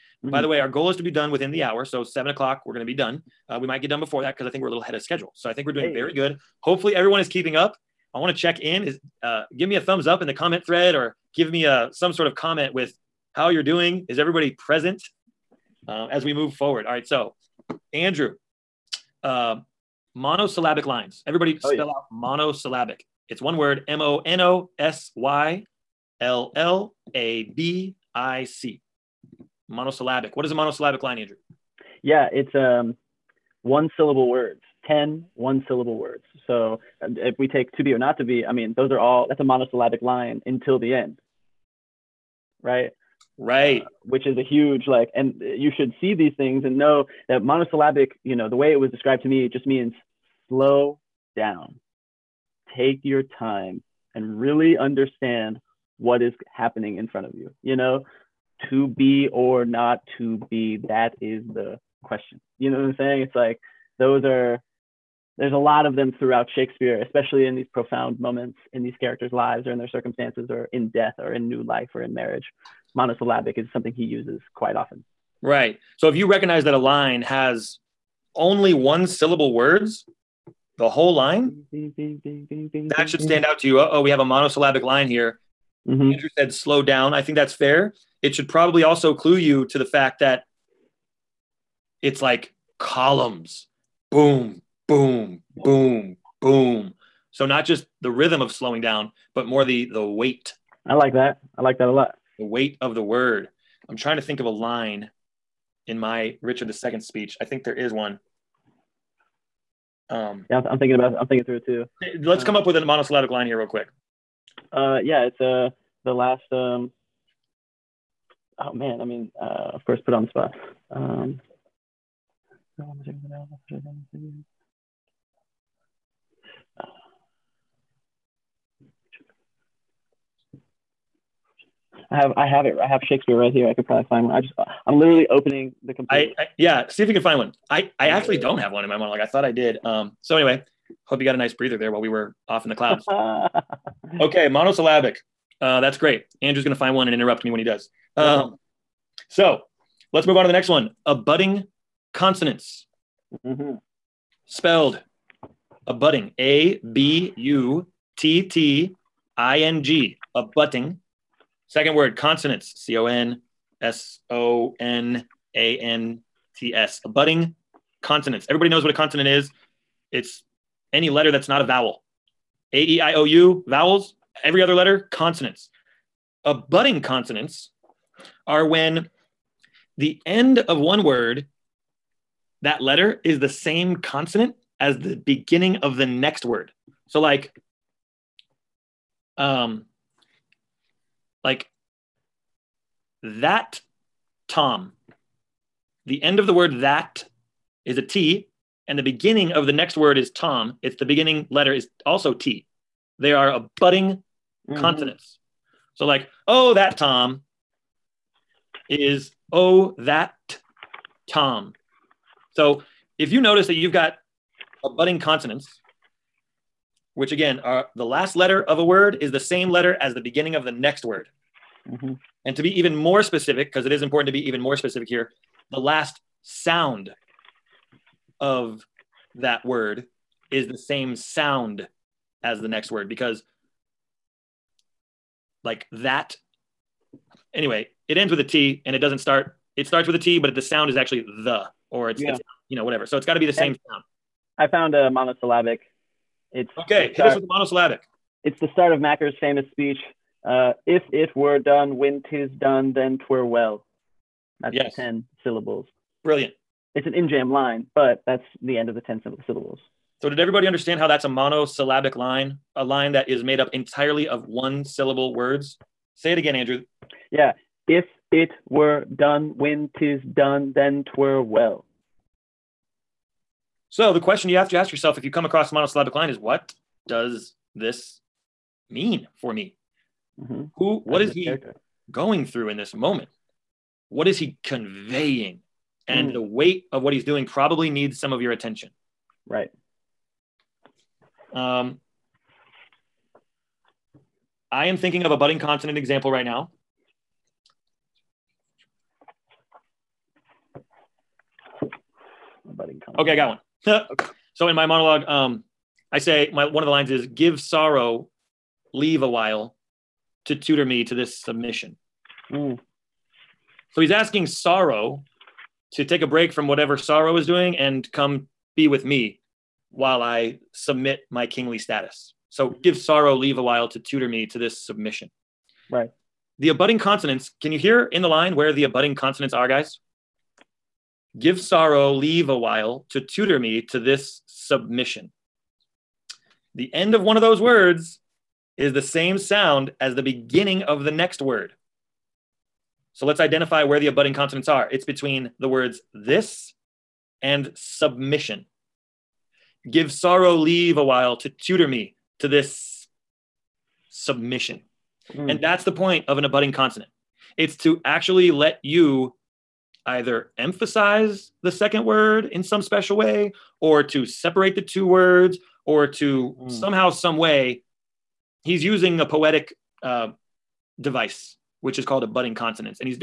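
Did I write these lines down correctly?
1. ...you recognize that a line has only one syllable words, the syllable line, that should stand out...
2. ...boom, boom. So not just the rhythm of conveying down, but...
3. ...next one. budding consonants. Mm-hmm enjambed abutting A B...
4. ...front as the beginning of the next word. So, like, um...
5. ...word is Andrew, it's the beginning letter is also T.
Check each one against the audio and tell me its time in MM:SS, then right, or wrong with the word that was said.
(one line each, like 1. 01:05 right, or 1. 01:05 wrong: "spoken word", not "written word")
1. 01:16 wrong: "whole", not "syllable"
2. 01:35 wrong: "slowing", not "conveying"
3. 02:30 wrong: "spelled", not "enjambed"
4. 03:03 wrong: "consonant", not "front"
5. 03:19 wrong: "Tom", not "Andrew".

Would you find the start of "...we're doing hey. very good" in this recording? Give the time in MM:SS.
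00:05.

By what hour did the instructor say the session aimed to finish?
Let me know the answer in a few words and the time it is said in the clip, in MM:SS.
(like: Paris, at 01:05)
7 o'clock, at 00:02.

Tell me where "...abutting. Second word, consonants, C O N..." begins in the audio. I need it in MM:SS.
02:40.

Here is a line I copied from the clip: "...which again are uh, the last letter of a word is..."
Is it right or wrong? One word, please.
right.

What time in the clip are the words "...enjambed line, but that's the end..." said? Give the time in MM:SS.
04:17.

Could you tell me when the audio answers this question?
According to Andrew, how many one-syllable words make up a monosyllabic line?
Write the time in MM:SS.
00:34.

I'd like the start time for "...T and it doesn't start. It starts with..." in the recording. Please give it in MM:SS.
03:58.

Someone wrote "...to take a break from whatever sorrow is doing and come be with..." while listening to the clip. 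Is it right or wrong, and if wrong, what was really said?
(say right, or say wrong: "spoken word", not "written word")
right.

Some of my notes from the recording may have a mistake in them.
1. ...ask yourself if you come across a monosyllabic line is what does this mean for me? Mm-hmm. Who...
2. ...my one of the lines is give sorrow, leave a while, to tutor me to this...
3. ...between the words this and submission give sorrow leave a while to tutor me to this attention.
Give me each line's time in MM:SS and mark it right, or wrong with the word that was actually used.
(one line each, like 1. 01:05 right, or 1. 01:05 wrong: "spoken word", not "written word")
1. 04:34 right
2. 05:06 right
3. 05:45 wrong: "submission", not "attention".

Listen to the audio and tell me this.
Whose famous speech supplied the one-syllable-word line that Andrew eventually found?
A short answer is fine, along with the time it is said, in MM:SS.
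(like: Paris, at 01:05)
Macbeth, at 04:08.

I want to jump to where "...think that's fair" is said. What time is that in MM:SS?
01:27.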